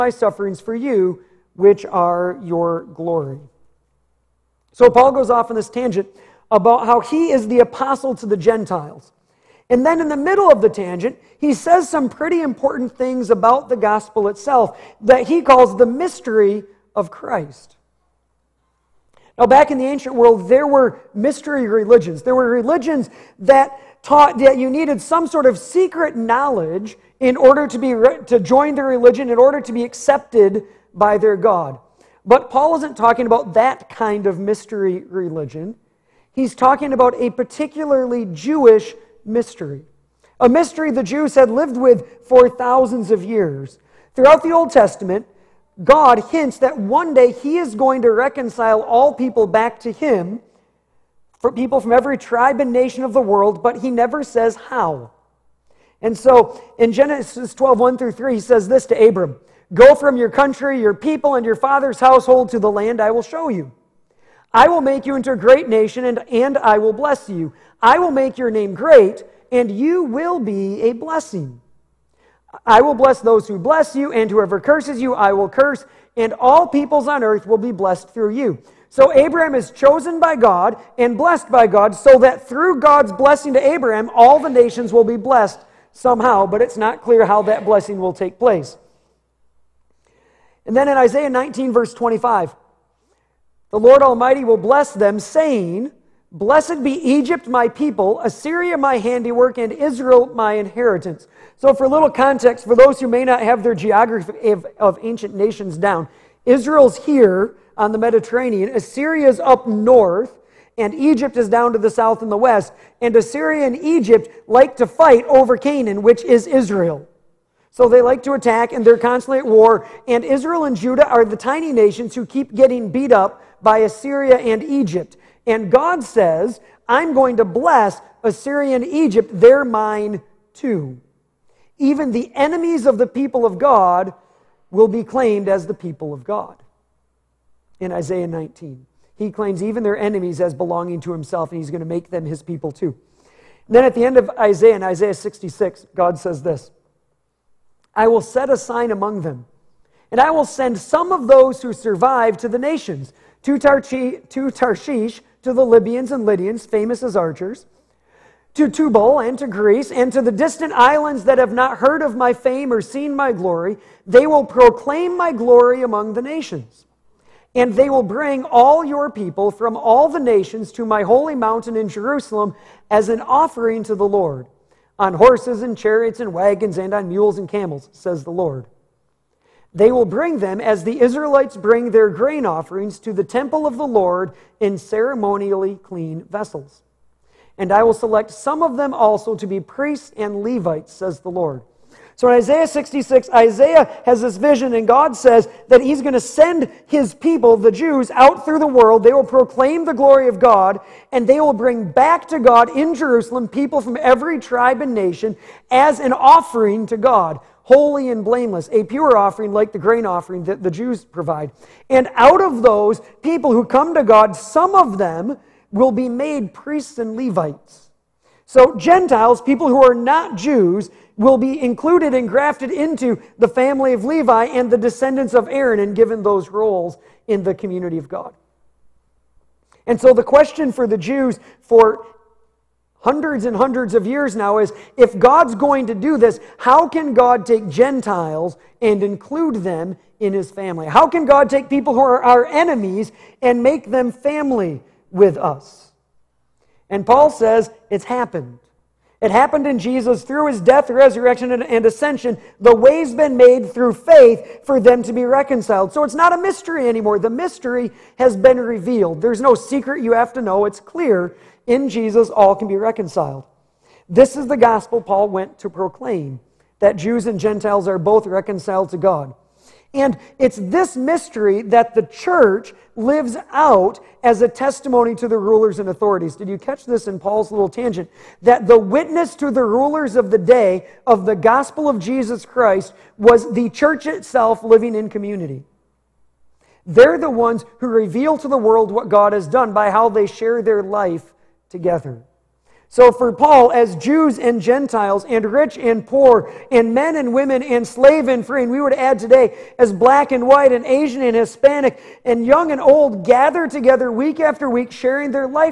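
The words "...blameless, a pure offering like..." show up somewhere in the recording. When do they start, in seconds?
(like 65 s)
208 s.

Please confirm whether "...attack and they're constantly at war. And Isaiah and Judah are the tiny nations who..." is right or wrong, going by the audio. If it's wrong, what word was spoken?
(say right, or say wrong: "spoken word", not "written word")
wrong: "Israel", not "Isaiah".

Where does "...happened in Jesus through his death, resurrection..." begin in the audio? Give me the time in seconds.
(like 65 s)
249 s.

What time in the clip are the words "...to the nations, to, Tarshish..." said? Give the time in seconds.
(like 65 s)
152 s.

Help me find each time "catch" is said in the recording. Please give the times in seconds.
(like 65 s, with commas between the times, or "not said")
276 s.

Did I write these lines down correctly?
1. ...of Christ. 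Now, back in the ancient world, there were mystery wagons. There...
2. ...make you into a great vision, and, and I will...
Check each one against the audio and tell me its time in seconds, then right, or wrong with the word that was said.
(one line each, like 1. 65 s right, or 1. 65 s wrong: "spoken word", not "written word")
1. 16 s wrong: "religions", not "wagons"
2. 64 s wrong: "nation", not "vision".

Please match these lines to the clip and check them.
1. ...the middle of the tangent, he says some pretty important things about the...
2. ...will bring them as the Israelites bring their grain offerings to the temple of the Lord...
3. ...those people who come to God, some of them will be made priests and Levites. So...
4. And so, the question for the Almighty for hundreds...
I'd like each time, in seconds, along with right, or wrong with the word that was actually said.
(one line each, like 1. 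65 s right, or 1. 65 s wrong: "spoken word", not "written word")
1. 10 s right
2. 179 s right
3. 212 s right
4. 229 s wrong: "Jews", not "Almighty".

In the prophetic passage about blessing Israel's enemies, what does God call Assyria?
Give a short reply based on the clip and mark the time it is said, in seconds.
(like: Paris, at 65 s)
my handiwork, at 98 s.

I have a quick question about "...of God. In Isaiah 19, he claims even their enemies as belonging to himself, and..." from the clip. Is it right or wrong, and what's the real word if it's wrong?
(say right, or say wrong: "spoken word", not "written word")
right.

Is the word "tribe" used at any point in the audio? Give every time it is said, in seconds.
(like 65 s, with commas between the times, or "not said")
52 s, 204 s.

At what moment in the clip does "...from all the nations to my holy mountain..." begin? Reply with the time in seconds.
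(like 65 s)
169 s.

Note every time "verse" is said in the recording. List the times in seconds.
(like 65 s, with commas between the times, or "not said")
91 s.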